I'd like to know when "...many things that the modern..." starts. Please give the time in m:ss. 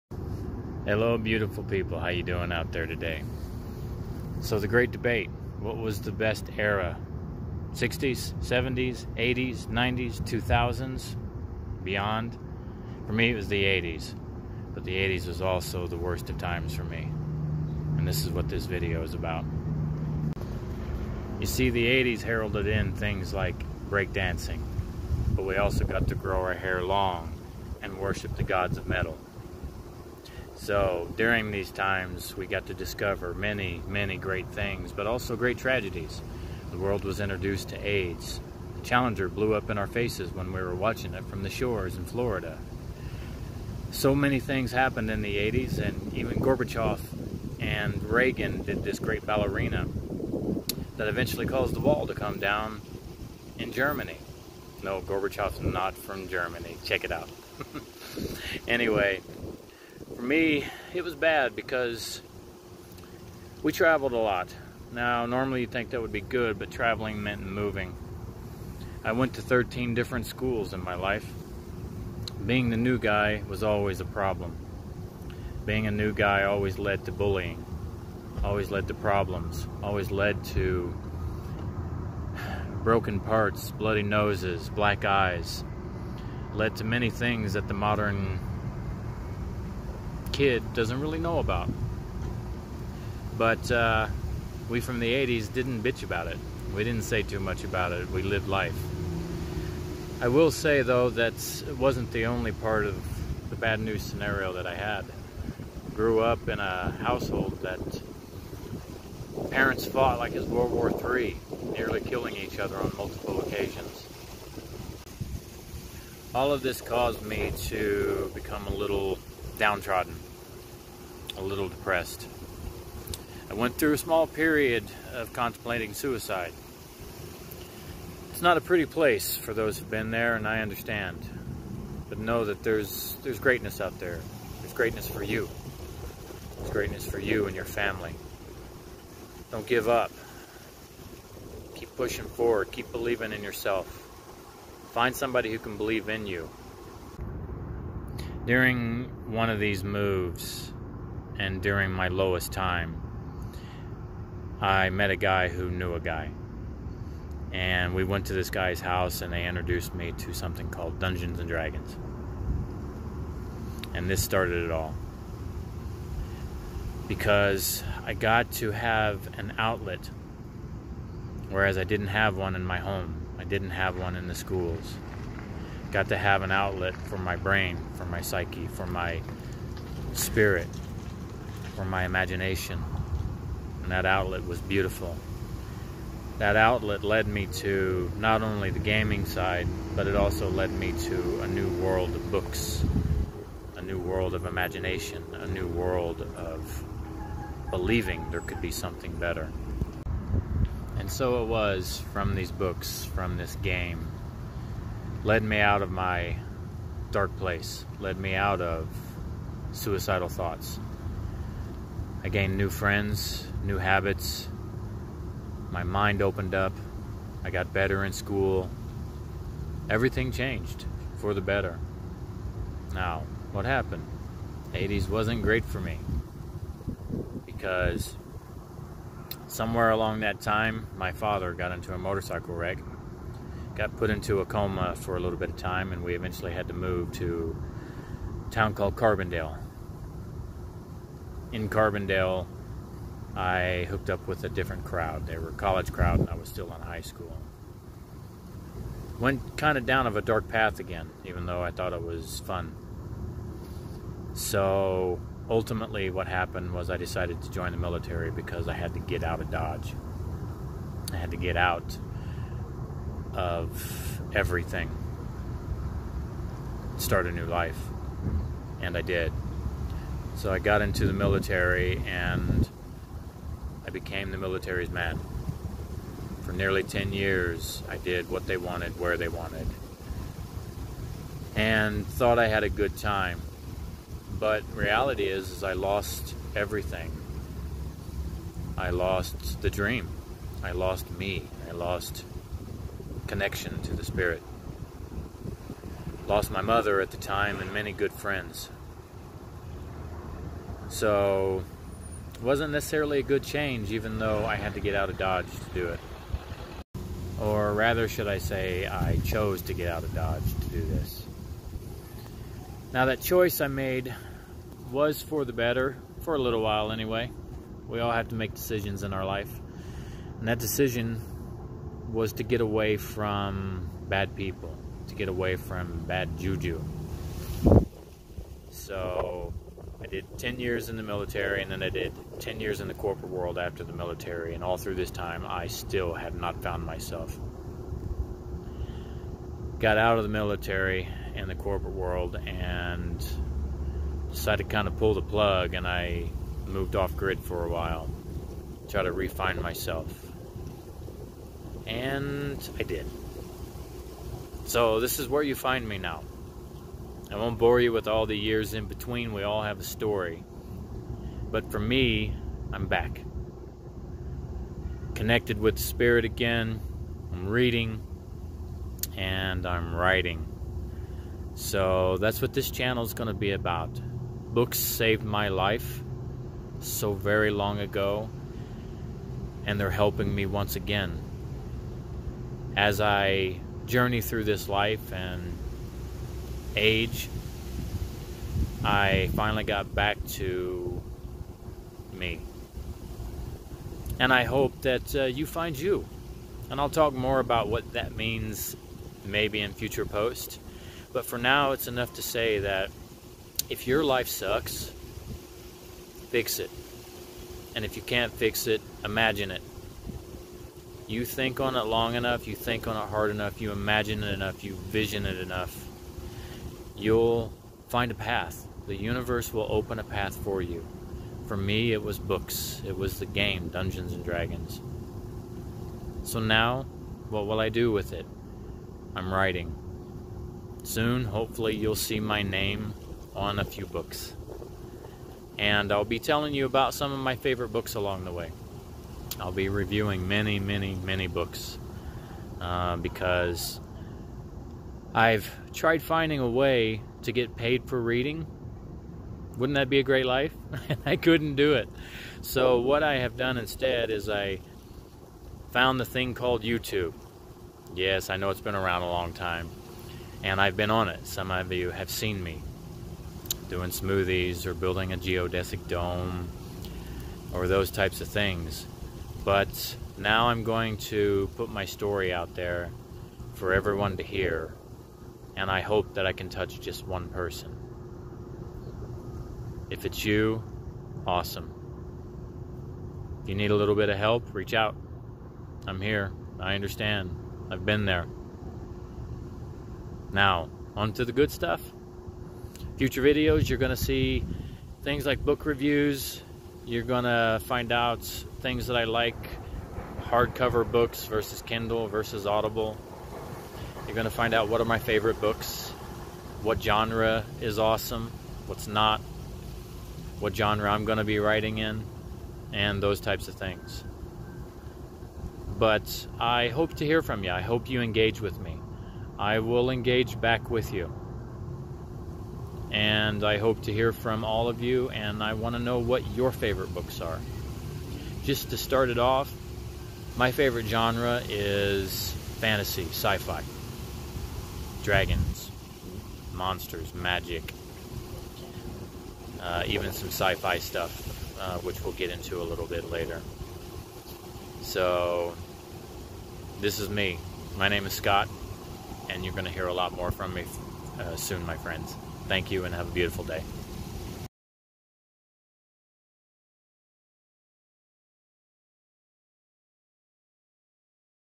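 1:26.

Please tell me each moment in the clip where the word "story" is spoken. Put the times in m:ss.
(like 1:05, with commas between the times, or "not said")
5:59, 7:51.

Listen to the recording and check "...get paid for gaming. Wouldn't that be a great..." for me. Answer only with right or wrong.
wrong.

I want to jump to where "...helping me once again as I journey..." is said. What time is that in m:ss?
6:19.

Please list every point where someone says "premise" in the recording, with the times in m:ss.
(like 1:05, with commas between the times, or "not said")
not said.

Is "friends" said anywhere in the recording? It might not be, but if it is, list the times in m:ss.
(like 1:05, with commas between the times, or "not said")
3:32, 4:58, 9:11.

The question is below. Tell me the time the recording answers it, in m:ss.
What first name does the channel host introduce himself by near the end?
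9:08.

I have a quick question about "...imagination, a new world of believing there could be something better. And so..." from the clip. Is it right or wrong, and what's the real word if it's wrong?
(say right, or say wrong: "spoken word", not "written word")
right.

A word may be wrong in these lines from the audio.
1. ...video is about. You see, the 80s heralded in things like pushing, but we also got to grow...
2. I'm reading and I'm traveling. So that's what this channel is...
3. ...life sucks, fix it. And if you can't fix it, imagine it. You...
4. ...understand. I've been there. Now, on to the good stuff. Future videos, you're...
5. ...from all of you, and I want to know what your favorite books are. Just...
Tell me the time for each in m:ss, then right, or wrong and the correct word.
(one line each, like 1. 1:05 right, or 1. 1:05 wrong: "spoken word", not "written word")
1. 0:18 wrong: "breakdancing", not "pushing"
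2. 6:07 wrong: "writing", not "traveling"
3. 6:44 right
4. 8:06 right
5. 8:44 right.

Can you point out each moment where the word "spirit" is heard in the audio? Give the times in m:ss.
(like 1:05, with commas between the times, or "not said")
3:00, 4:54, 6:05.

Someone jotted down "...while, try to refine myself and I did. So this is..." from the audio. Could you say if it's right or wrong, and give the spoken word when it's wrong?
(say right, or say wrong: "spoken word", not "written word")
right.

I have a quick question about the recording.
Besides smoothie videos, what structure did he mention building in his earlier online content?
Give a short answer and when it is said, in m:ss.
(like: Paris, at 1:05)
a geodesic dome, at 7:45.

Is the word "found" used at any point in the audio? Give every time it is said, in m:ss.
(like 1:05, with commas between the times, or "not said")
5:36, 7:35.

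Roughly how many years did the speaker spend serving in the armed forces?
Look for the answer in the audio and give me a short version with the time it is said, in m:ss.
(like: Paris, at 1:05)
10 years, at 4:36.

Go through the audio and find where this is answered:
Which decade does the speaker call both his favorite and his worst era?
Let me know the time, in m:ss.
0:13.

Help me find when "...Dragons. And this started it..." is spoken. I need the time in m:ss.
2:41.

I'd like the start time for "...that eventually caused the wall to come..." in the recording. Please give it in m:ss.
0:50.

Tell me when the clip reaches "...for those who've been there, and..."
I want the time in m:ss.
2:09.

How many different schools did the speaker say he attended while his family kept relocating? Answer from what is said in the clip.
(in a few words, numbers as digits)
13.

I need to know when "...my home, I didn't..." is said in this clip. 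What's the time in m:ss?
2:52.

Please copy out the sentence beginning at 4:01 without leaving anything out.
In Carbondale, I hooked up with a different crowd.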